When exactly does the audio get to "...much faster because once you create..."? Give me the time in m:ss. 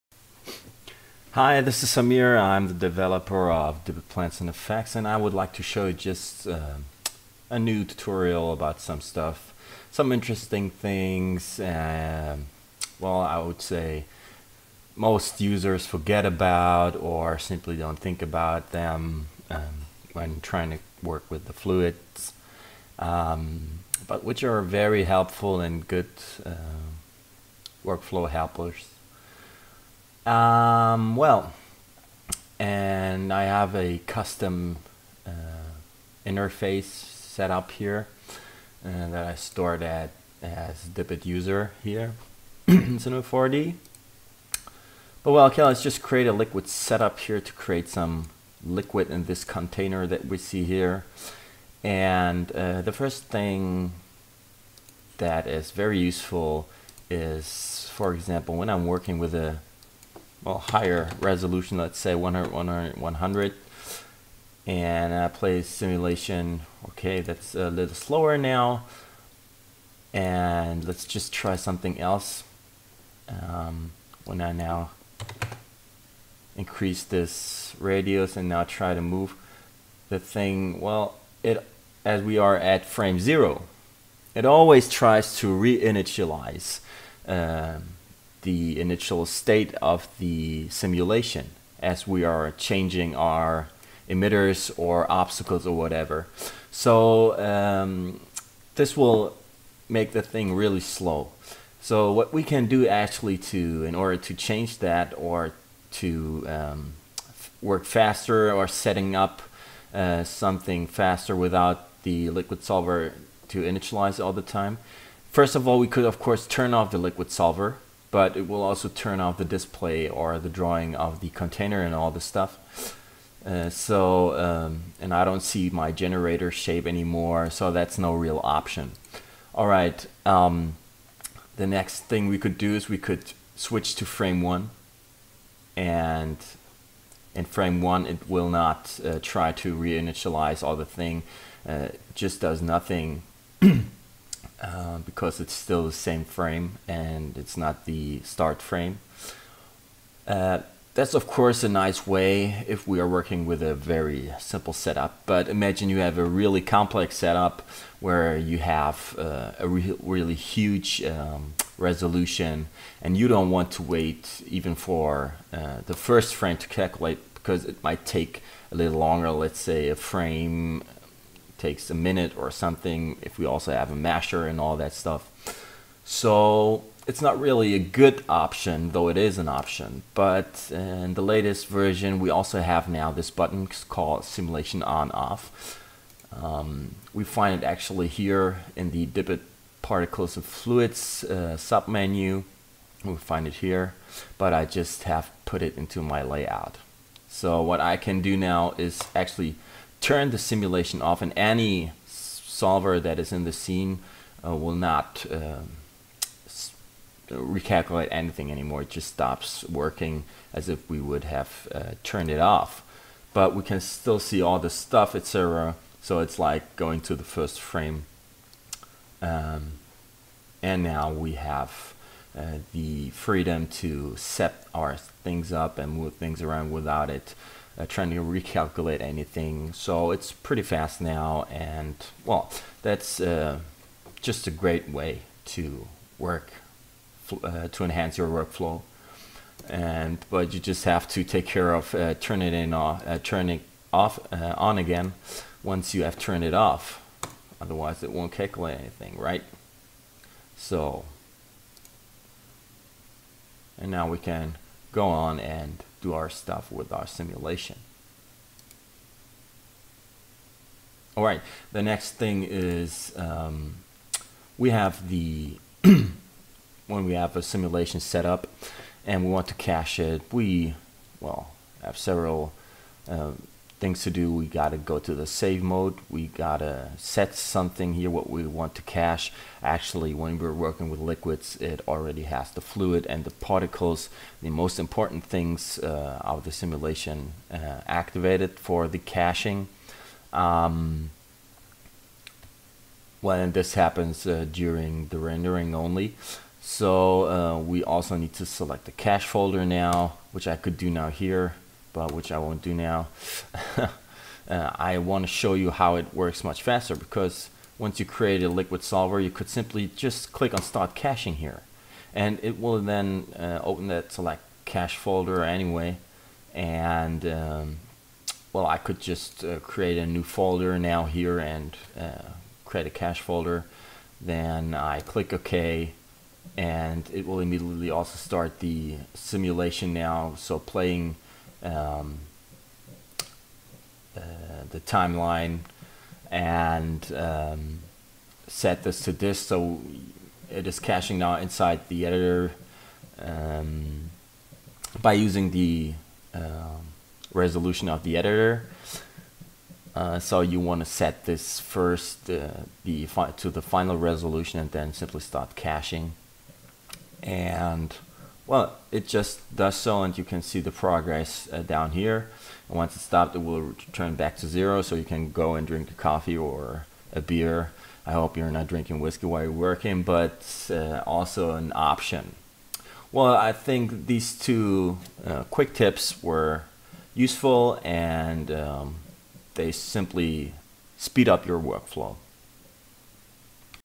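5:06.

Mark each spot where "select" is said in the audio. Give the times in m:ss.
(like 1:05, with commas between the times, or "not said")
4:58, 5:14.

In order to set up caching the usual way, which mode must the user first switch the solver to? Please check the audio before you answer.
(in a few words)
save mode.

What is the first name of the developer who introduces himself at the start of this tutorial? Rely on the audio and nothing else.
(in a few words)
Samir.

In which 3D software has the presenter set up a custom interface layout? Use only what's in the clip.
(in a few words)
Cinema 4D.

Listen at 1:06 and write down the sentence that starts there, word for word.
Okay, that's a little slower now.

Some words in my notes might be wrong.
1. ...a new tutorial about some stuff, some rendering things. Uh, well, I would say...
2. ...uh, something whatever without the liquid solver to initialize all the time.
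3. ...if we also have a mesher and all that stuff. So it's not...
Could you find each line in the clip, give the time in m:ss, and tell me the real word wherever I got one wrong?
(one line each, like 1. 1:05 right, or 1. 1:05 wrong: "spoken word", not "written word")
1. 0:07 wrong: "interesting", not "rendering"
2. 1:49 wrong: "faster", not "whatever"
3. 2:53 right.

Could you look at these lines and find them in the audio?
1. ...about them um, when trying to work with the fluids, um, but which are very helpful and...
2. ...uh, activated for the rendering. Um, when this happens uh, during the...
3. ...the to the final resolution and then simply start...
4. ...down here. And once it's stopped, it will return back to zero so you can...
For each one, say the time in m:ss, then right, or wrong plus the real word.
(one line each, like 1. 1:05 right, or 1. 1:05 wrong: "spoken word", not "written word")
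1. 0:18 right
2. 4:47 wrong: "caching", not "rendering"
3. 5:52 right
4. 6:01 right.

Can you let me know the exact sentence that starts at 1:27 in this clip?
Um, the initial state of the simulation as we are changing our emitters or obstacles or whatever.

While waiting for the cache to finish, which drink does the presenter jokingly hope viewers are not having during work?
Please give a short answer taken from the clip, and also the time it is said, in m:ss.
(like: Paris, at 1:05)
whiskey, at 6:08.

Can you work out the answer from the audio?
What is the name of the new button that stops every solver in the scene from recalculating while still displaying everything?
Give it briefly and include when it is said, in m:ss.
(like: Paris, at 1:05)
simulation on off, at 3:04.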